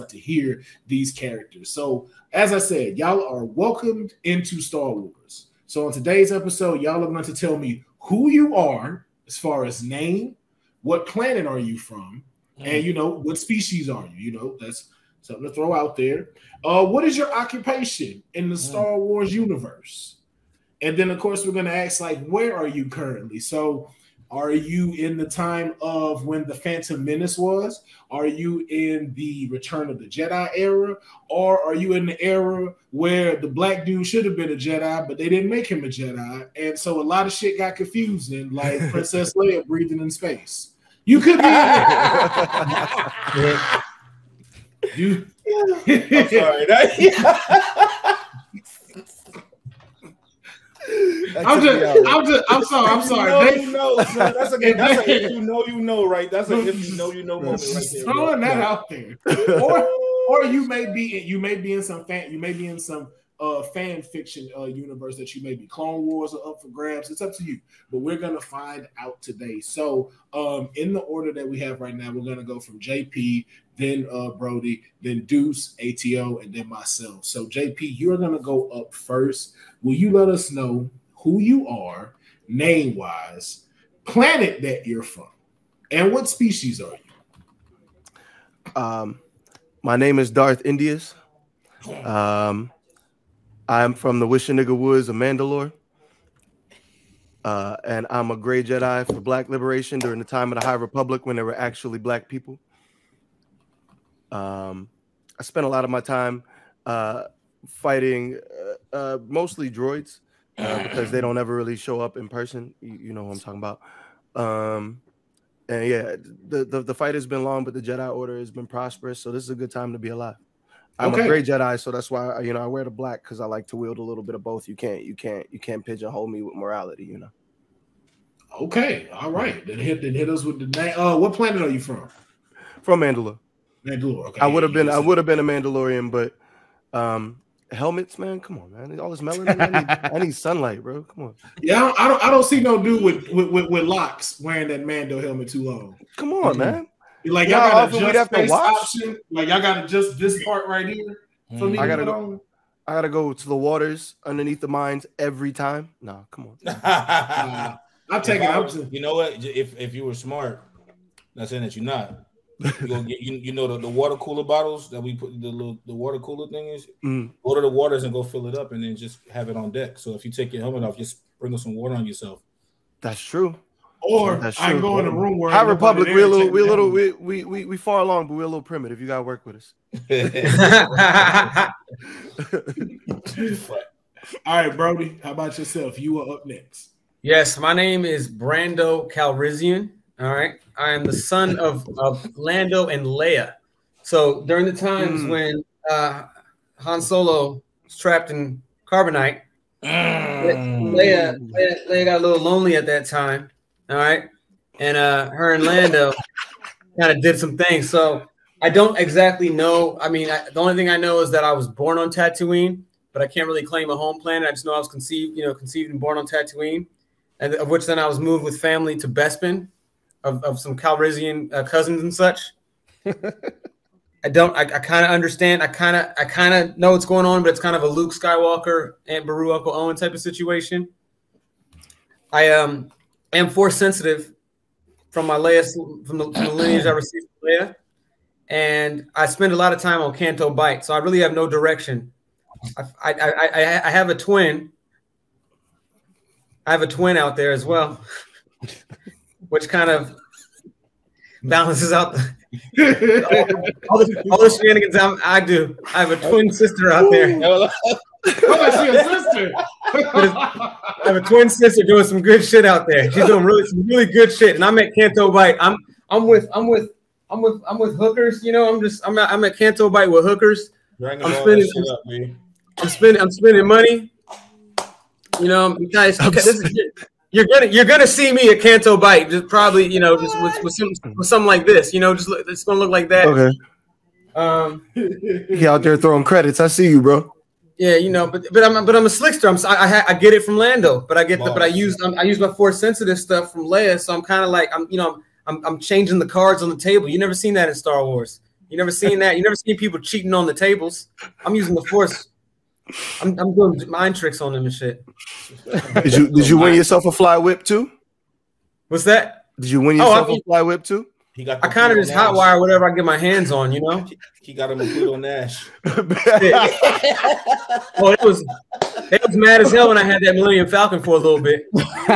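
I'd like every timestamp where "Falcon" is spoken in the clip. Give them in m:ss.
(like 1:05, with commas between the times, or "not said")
5:20.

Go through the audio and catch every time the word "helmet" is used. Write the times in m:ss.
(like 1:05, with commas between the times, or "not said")
2:17, 2:25, 2:50.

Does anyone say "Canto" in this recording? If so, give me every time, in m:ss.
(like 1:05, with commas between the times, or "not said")
4:00, 4:24, 4:29, 4:38.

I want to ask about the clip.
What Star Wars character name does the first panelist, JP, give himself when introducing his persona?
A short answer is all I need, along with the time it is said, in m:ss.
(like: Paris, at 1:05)
Darth Indius, at 1:30.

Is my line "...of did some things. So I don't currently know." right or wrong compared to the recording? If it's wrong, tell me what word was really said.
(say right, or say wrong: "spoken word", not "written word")
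wrong: "exactly", not "currently".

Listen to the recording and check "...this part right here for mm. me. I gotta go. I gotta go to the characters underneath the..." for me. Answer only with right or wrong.
wrong.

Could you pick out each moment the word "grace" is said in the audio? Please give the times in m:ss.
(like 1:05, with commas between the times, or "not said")
not said.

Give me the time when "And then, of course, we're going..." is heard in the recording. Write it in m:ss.
0:20.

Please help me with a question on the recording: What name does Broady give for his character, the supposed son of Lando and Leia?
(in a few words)
Brando Calrissian.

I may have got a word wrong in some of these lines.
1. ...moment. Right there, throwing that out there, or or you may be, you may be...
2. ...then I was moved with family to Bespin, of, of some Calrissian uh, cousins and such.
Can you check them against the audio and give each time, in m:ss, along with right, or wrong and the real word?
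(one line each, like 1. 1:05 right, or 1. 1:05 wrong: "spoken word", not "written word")
1. 0:57 right
2. 3:37 right.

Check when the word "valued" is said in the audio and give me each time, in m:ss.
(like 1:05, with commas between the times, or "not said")
not said.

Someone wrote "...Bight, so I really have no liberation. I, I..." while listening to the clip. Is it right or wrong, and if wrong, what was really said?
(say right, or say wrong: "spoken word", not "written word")
wrong: "direction", not "liberation".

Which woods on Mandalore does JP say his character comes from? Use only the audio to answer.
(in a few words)
Wishinaga Woods.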